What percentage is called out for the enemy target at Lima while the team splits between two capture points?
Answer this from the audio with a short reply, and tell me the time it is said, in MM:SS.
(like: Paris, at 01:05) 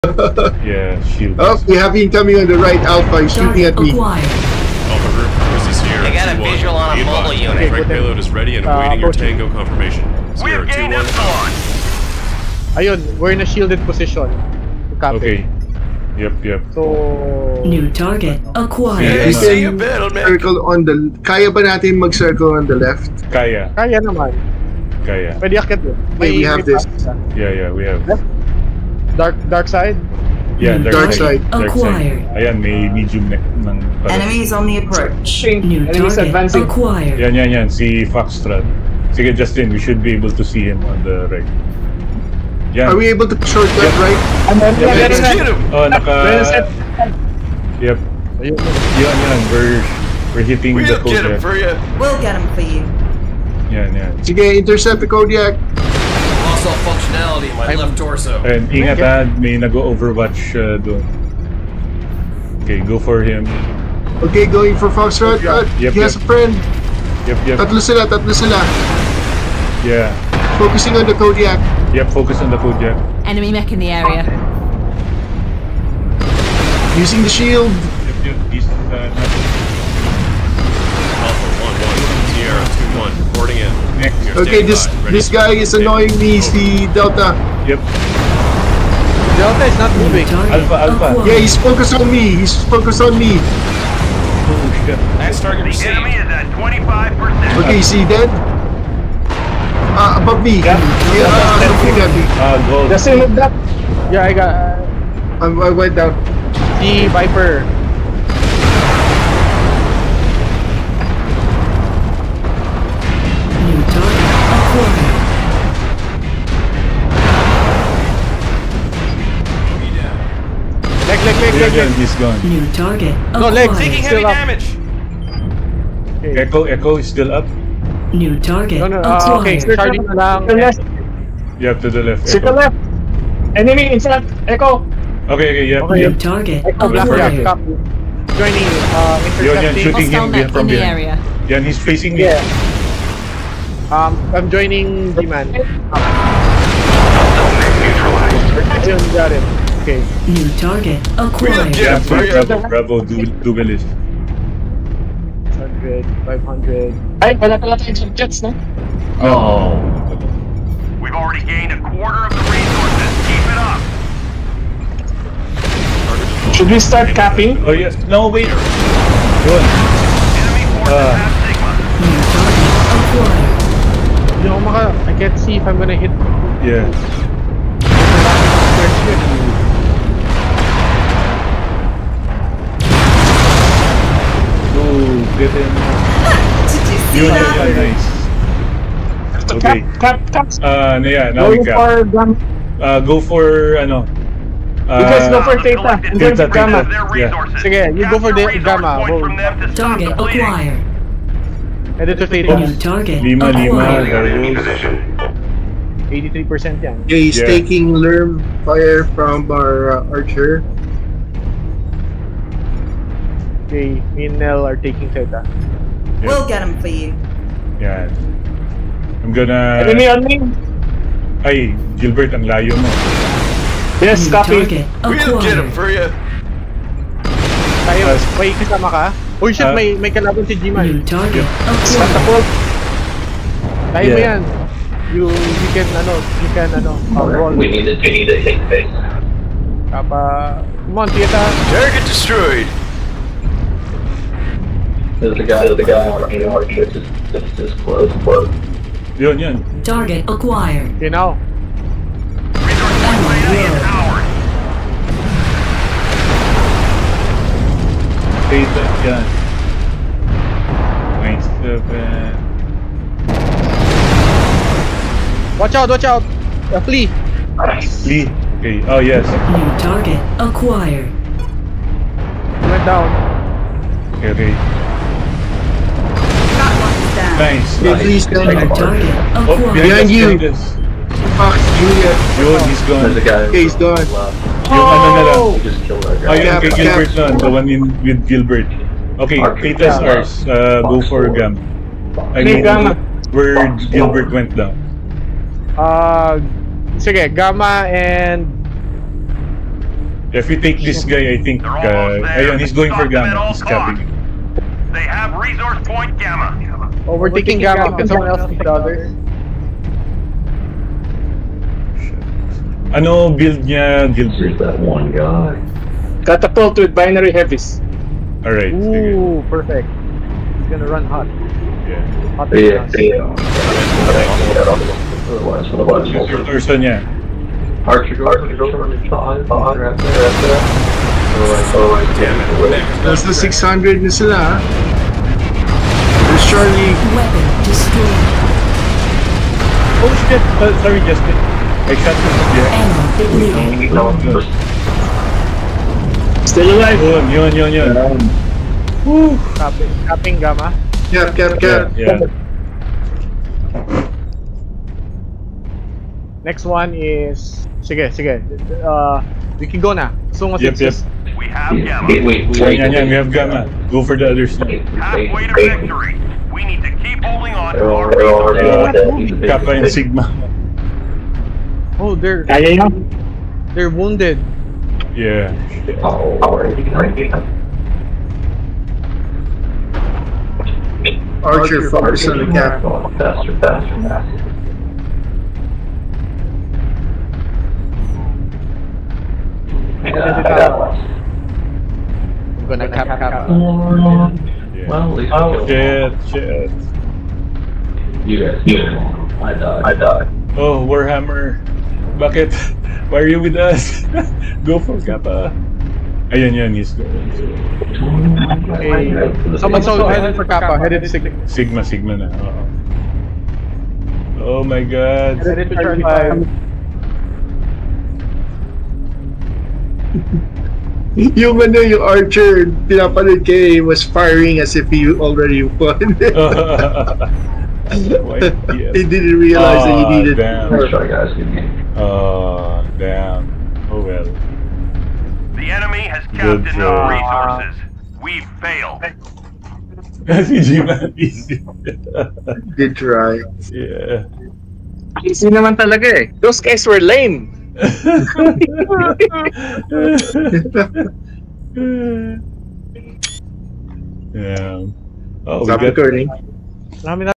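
83%, at 03:26.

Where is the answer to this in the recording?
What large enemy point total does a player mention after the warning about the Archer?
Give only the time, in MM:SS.
05:33.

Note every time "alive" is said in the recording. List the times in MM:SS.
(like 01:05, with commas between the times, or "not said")
05:46.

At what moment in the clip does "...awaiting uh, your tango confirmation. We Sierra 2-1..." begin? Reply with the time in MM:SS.
00:08.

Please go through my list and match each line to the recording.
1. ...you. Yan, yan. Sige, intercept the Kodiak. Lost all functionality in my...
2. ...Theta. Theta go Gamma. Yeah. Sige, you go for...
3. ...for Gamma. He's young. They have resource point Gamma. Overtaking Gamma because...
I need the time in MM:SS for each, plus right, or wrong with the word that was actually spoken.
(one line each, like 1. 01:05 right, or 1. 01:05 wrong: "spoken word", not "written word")
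1. 00:52 right
2. 03:15 right
3. 05:02 wrong: "capping", not "young".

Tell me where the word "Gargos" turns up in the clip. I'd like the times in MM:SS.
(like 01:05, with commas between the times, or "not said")
03:24.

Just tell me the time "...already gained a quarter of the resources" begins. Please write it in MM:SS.
02:41.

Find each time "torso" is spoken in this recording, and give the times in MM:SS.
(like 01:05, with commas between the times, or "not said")
00:57, 05:26.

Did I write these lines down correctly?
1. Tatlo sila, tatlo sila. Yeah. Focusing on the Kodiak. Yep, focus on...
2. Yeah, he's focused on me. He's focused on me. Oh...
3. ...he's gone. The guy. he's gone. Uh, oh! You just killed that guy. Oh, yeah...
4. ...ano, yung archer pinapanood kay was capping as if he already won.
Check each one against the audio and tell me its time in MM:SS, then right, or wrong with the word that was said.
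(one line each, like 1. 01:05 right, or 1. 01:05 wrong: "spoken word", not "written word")
1. 01:07 right
2. 01:31 right
3. 04:42 right
4. 07:01 wrong: "firing", not "capping".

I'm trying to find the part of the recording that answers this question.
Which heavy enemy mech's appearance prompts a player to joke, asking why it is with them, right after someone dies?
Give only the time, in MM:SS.
06:40.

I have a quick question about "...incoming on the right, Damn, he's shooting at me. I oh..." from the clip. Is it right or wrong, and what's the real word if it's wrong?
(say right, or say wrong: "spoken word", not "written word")
wrong: "Alpha", not "Damn".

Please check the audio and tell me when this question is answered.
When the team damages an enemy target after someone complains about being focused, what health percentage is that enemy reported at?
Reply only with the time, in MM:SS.
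01:36.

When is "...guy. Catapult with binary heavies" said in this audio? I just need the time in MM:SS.
05:15.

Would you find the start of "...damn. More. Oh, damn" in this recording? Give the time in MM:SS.
07:10.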